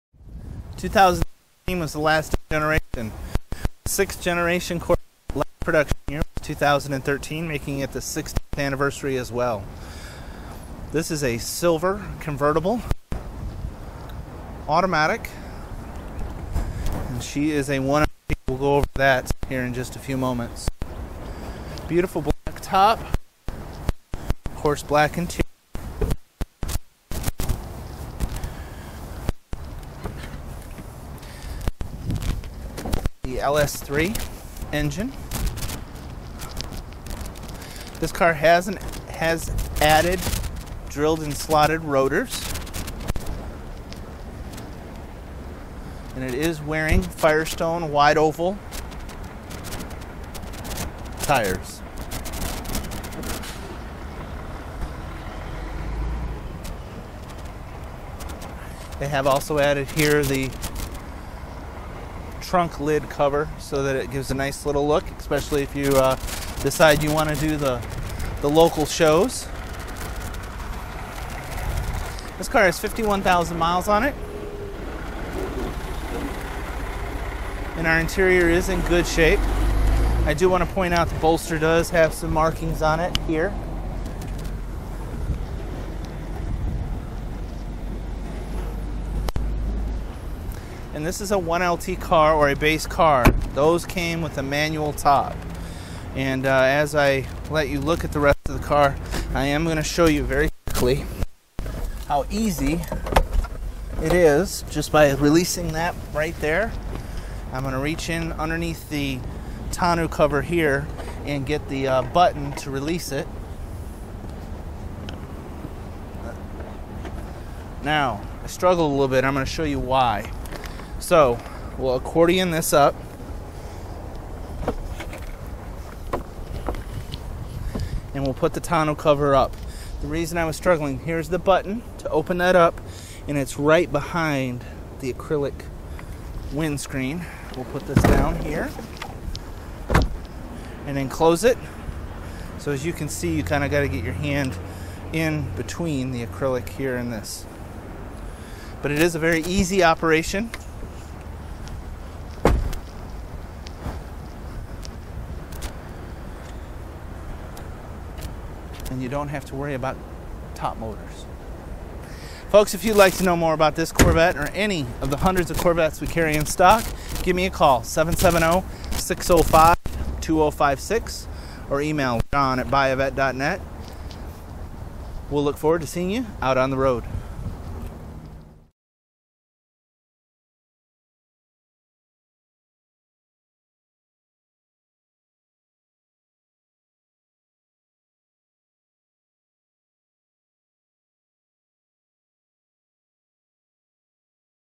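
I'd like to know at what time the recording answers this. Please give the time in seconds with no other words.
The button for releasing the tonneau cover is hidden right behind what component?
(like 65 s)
135 s.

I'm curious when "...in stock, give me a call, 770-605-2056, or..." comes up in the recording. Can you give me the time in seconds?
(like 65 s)
166 s.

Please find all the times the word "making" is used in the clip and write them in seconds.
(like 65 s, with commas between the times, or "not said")
7 s.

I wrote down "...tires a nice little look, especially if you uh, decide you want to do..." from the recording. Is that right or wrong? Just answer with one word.
wrong.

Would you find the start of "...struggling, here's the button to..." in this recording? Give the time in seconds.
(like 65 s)
130 s.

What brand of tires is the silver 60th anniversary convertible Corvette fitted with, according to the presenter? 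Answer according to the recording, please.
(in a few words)
Firestone.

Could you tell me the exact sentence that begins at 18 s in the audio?
We'll go over that here in just a few moments.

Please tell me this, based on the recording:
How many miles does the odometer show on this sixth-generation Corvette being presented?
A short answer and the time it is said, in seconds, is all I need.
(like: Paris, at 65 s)
51,000, at 72 s.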